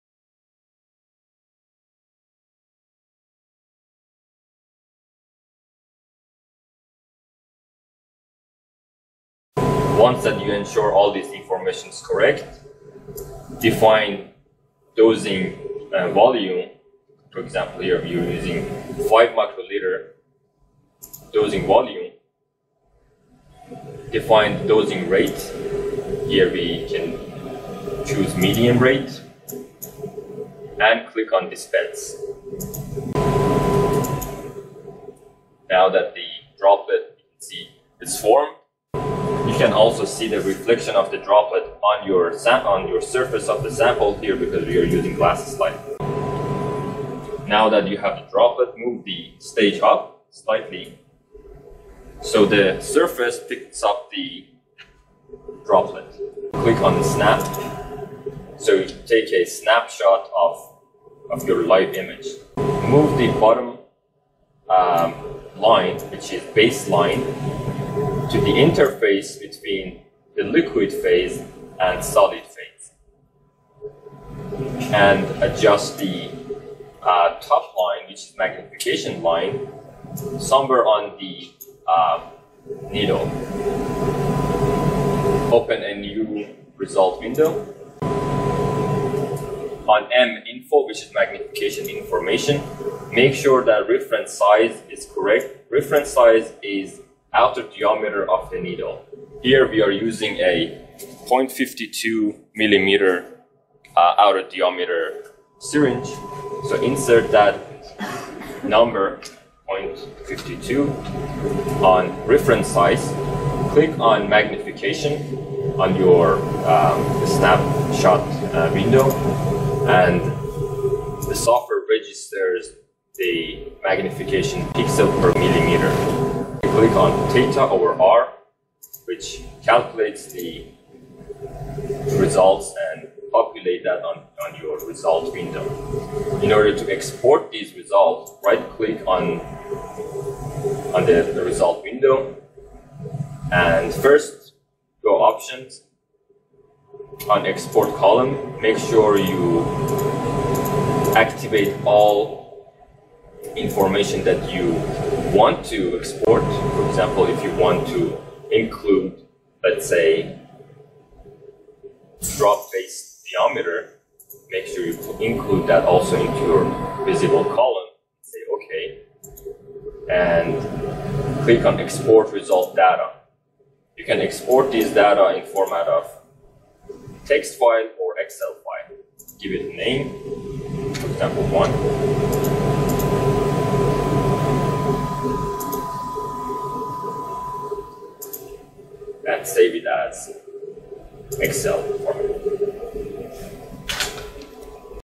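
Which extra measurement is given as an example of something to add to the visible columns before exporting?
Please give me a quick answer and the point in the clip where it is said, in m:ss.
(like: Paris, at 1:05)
Drop-base diameter, at 2:42.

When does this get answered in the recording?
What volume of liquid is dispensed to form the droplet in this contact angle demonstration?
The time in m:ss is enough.
0:19.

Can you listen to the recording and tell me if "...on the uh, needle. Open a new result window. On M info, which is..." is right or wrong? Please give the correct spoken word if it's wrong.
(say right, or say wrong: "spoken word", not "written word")
right.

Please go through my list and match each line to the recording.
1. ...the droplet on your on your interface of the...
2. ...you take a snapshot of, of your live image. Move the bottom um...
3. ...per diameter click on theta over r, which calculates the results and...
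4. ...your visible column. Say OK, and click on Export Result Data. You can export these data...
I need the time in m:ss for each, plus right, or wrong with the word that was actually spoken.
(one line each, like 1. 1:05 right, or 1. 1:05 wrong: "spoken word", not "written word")
1. 0:41 wrong: "surface", not "interface"
2. 0:58 right
3. 2:05 wrong: "millimeter", not "diameter"
4. 2:46 right.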